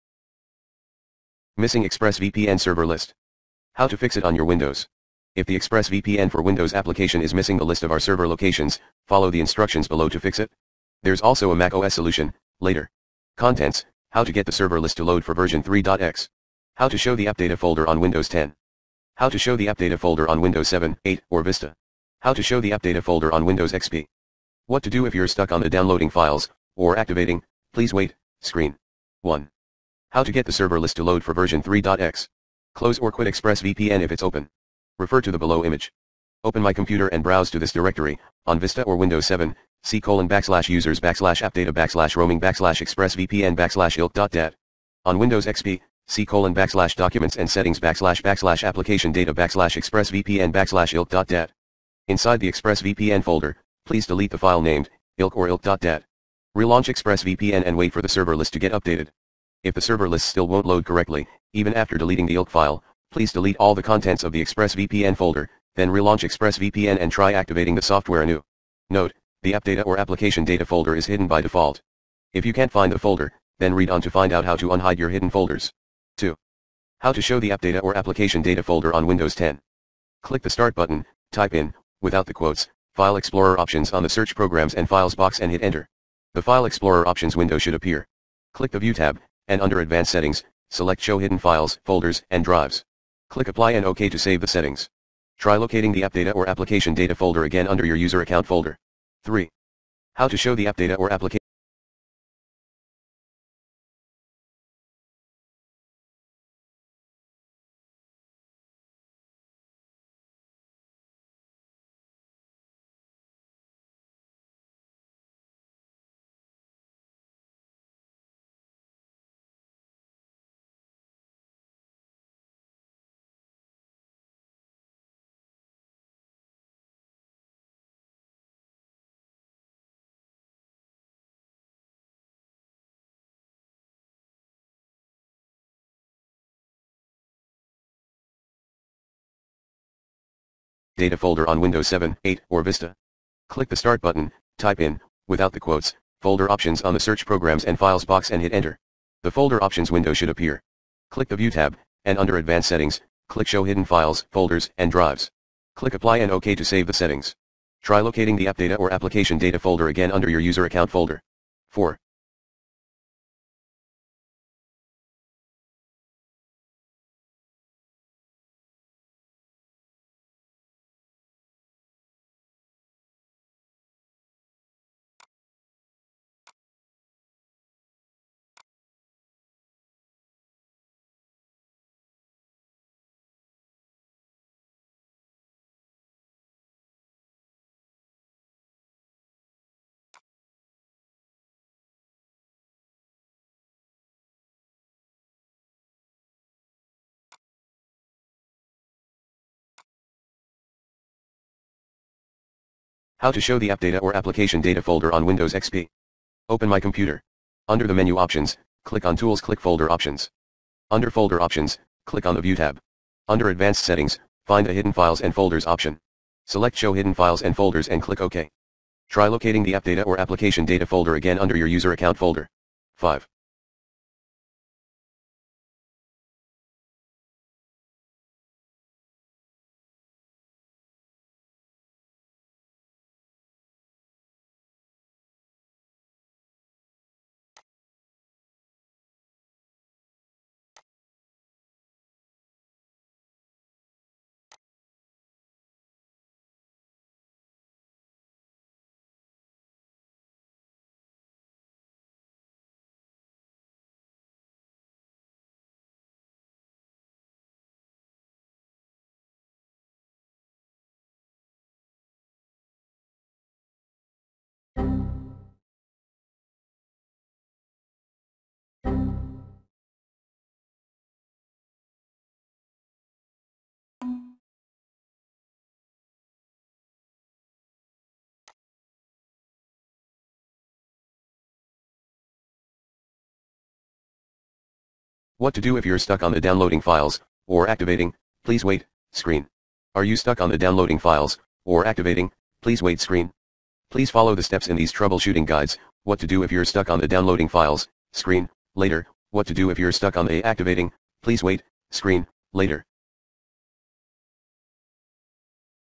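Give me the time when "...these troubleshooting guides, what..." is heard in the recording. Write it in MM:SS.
04:54.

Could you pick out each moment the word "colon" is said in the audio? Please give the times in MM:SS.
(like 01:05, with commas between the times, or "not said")
00:40, 00:46.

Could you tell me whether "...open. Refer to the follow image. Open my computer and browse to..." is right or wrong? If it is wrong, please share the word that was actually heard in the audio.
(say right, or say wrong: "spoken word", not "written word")
wrong: "below", not "follow".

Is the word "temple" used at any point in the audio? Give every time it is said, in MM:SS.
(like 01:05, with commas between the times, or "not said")
not said.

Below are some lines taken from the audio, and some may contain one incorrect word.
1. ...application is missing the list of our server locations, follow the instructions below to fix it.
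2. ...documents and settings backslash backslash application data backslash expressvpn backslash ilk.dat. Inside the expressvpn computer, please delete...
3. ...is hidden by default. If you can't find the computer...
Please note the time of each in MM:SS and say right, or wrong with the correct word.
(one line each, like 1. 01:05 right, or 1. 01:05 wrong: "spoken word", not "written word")
1. 00:06 right
2. 00:46 wrong: "folder", not "computer"
3. 01:10 wrong: "folder", not "computer".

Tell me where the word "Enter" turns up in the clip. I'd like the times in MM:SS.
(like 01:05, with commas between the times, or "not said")
01:25, 02:28.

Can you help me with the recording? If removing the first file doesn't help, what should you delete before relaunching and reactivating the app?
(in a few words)
all the contents.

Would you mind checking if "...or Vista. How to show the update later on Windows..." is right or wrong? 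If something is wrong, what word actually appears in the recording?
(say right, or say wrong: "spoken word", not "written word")
wrong: "folder", not "later".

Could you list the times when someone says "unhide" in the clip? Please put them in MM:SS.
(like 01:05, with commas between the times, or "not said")
01:14.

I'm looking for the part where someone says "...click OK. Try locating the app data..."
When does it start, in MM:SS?
03:38.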